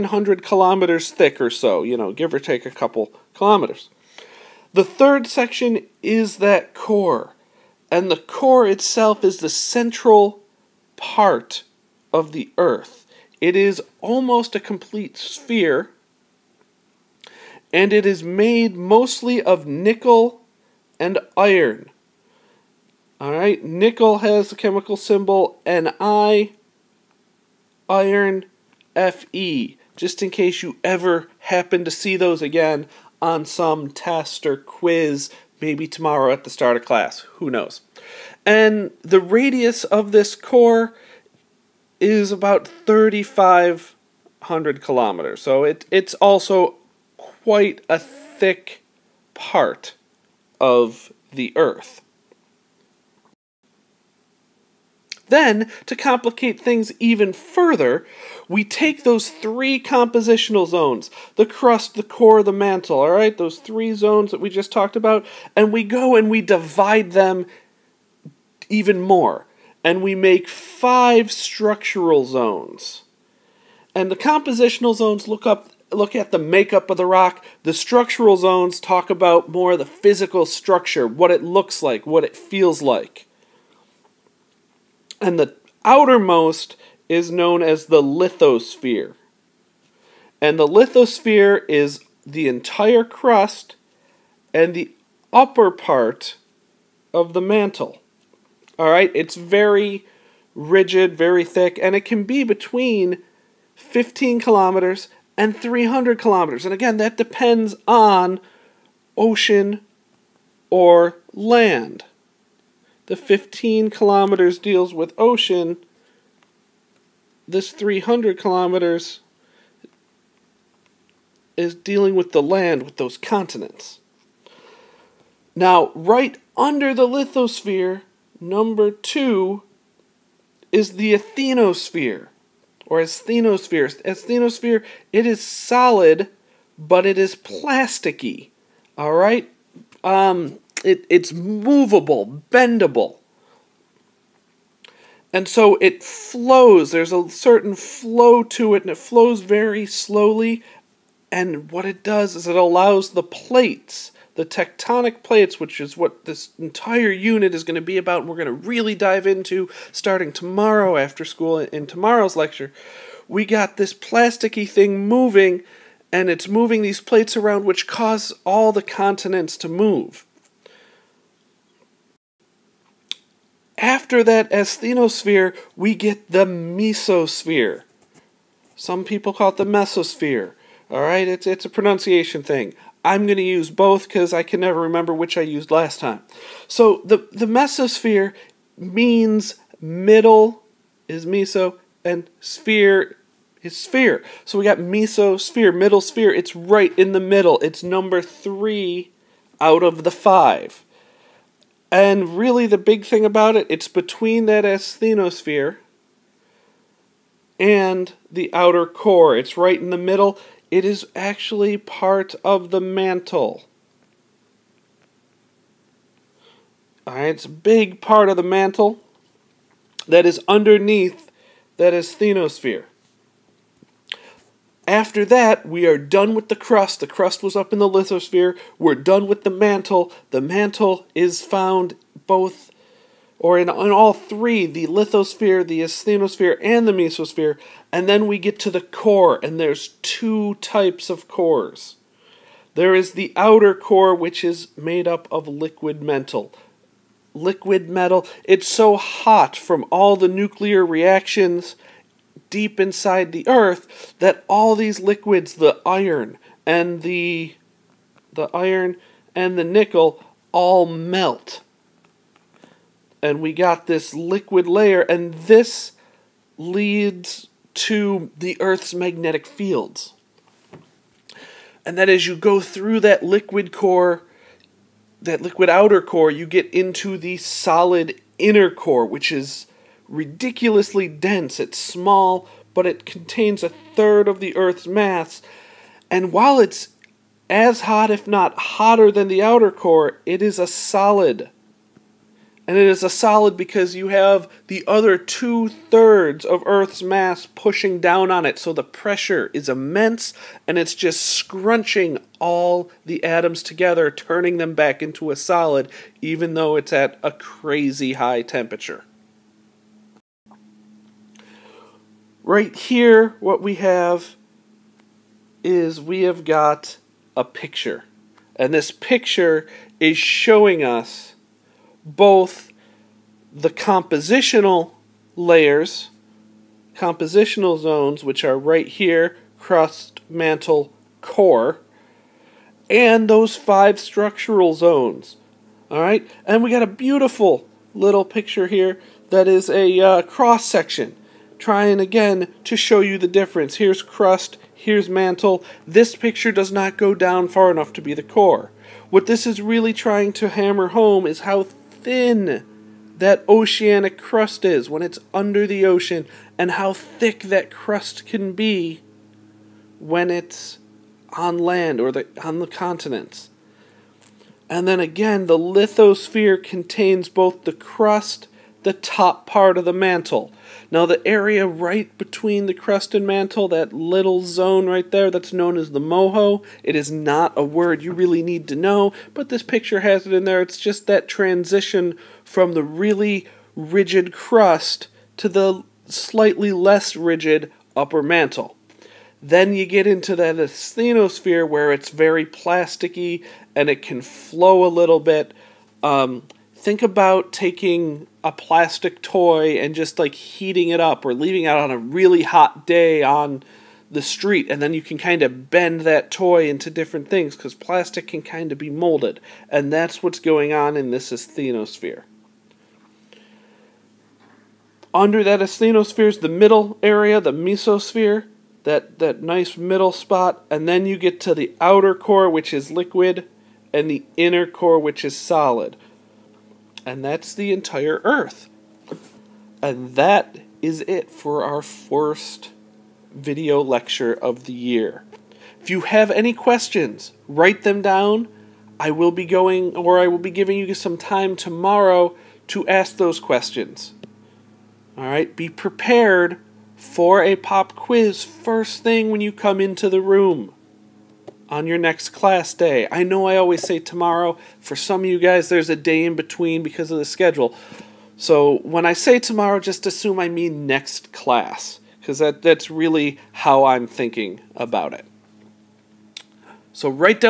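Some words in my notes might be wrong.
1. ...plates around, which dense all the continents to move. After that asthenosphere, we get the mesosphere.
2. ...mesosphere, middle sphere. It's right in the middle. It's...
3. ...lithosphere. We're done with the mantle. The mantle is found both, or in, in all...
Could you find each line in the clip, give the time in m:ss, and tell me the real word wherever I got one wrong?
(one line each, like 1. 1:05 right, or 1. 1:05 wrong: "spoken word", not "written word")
1. 2:47 wrong: "cause", not "dense"
2. 3:14 right
3. 3:47 right.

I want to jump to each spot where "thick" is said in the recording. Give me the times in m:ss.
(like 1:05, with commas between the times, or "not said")
0:01, 0:47, 1:41, 5:56.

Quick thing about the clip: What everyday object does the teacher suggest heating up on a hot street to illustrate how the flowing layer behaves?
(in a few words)
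plastic toy.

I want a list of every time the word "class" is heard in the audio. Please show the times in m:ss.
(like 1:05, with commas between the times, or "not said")
0:36, 7:32, 7:41.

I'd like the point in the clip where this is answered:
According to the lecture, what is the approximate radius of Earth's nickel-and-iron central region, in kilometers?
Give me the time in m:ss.
0:42.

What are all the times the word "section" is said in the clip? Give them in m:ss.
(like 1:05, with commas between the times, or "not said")
0:05, 5:40.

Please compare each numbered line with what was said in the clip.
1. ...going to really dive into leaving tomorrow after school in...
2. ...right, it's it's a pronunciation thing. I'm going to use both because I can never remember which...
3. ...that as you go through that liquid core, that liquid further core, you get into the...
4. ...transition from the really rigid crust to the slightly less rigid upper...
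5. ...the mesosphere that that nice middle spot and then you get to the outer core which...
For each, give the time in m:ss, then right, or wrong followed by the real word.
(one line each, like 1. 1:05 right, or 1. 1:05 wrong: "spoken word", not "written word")
1. 2:38 wrong: "starting", not "leaving"
2. 3:01 right
3. 4:31 wrong: "outer", not "further"
4. 6:21 right
5. 6:57 right.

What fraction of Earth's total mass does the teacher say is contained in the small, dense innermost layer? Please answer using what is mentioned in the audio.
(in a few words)
a third.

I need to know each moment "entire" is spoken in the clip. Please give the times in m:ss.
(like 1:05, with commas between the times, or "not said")
1:32, 2:36, 7:07.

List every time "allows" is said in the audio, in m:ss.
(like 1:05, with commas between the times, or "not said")
2:32.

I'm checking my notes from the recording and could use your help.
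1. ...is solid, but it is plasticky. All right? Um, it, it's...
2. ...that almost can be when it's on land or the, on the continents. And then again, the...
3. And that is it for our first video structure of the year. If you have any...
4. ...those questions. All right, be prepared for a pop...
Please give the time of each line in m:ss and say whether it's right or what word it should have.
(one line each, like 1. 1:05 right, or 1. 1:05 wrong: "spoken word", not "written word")
1. 2:15 right
2. 5:57 wrong: "crust", not "almost"
3. 7:09 wrong: "lecture", not "structure"
4. 7:23 right.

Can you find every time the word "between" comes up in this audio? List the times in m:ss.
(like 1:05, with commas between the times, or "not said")
1:42, 3:23, 6:12, 7:36.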